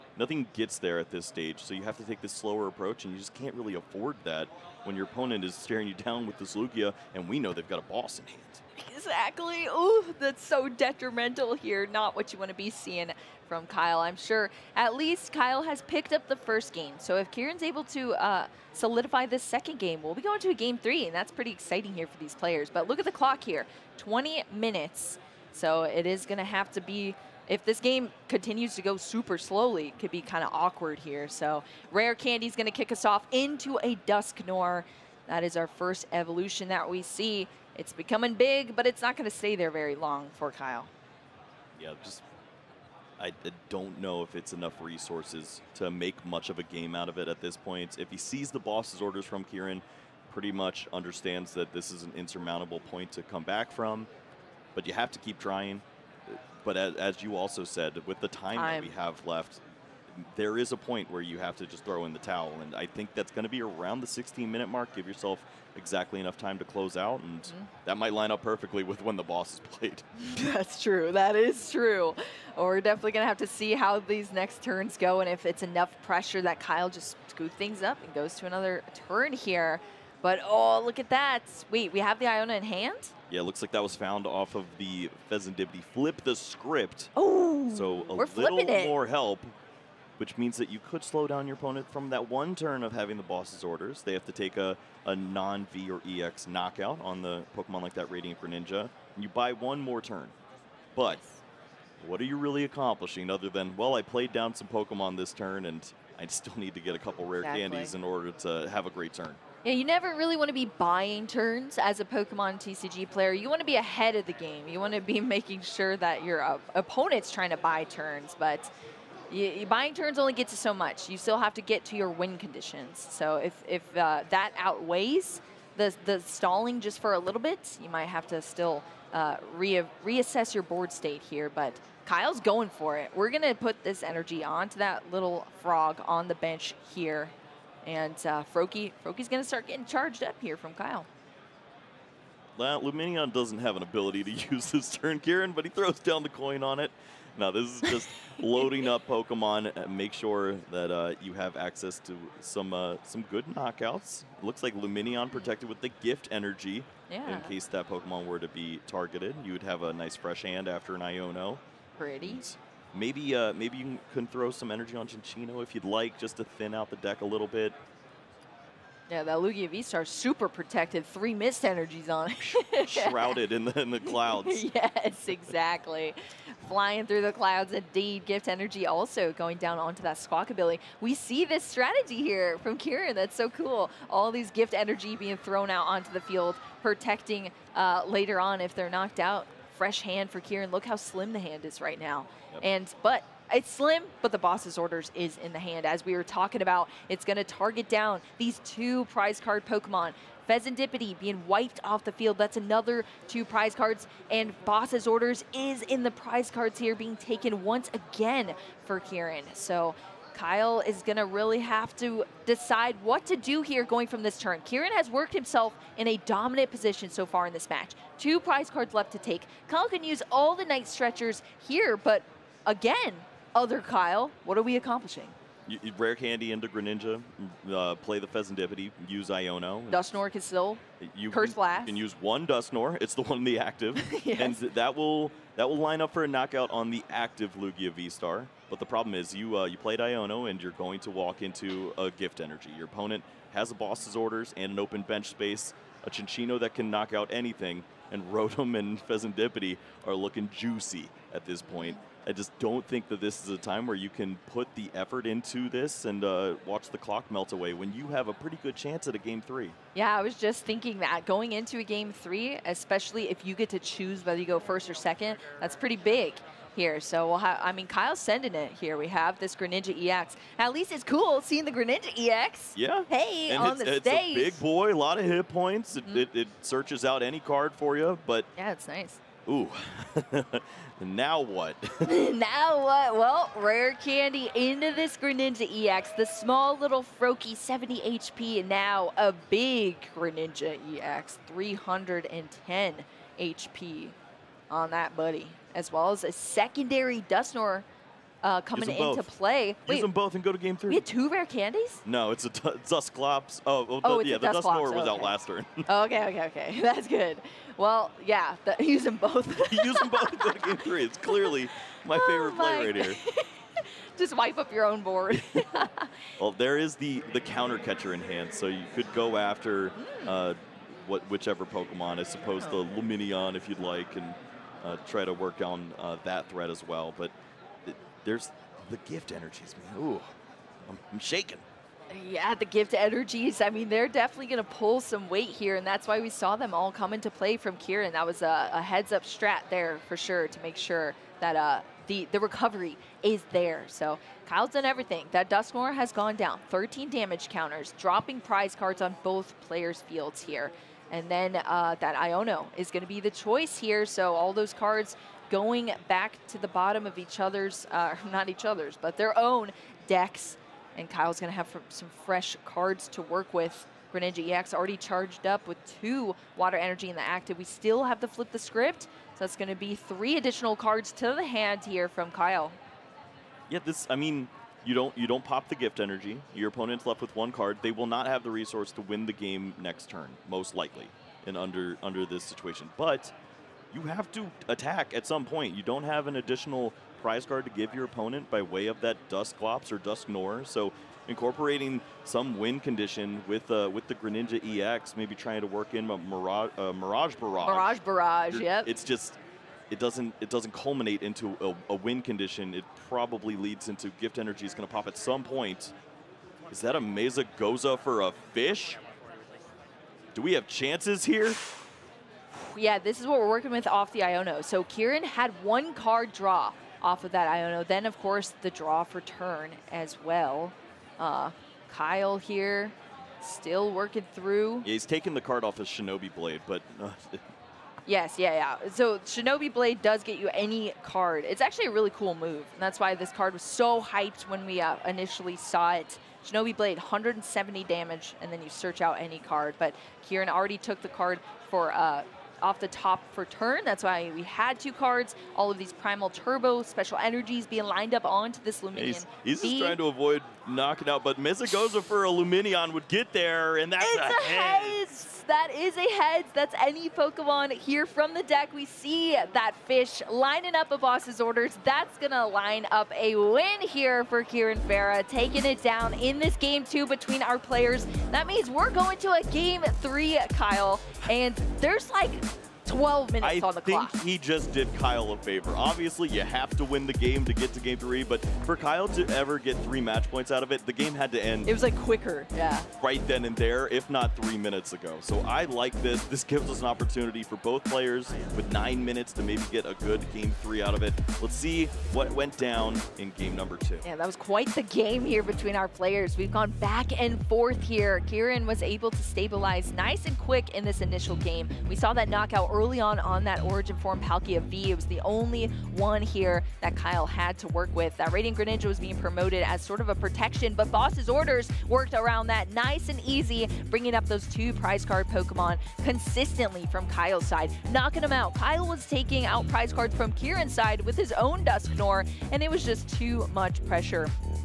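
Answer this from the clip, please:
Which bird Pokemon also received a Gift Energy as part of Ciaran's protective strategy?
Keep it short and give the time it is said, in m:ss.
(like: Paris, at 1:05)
Squawkabilly, at 3:00.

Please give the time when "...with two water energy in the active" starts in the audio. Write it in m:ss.
6:05.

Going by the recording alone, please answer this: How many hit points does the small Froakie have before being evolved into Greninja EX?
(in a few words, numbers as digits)
70.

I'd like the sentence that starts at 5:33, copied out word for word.
I mean, they're definitely going to pull some weight here, and that's why we saw them all come into play from Ciaran.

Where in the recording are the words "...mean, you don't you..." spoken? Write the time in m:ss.
6:14.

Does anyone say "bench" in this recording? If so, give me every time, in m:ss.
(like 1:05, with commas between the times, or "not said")
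2:16, 4:05.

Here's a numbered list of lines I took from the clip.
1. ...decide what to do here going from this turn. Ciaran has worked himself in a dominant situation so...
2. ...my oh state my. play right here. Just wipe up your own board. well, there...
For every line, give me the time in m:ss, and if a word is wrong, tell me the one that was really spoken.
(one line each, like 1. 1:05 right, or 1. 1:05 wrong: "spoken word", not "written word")
1. 3:32 wrong: "position", not "situation"
2. 5:12 wrong: "favorite", not "state".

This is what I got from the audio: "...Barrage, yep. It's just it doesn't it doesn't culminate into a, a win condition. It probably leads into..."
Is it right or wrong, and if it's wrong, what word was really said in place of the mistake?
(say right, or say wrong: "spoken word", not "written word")
right.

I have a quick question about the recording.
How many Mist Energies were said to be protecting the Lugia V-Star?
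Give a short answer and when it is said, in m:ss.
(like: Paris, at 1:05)
3, at 2:51.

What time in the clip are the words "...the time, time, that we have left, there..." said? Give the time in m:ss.
0:58.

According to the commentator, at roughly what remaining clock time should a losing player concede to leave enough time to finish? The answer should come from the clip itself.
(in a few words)
16 minutes.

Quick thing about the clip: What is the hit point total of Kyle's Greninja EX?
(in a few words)
310.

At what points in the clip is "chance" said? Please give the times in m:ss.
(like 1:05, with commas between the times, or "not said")
4:18, 6:50.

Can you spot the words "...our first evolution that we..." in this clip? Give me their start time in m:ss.
0:35.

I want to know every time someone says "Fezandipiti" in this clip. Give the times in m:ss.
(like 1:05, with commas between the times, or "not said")
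1:25, 3:20, 3:48, 4:09.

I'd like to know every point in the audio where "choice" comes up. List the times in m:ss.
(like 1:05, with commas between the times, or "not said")
5:53.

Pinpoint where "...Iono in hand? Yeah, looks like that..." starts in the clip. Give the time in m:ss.
1:22.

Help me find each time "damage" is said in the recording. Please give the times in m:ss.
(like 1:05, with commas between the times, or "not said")
5:47, 7:17.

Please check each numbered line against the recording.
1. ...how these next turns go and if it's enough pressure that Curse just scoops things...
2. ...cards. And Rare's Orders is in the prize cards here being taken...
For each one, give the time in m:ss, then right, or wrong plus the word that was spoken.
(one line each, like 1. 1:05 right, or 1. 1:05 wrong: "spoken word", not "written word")
1. 1:13 wrong: "Kyle", not "Curse"
2. 3:23 wrong: "Boss", not "Rare".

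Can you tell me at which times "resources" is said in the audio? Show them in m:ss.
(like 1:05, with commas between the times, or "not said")
0:44, 6:18.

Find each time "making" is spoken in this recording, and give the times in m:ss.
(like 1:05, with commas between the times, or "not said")
1:55.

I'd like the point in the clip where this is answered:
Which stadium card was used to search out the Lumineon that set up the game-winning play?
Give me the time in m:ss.
7:31.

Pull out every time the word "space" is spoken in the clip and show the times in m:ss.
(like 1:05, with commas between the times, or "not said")
4:05.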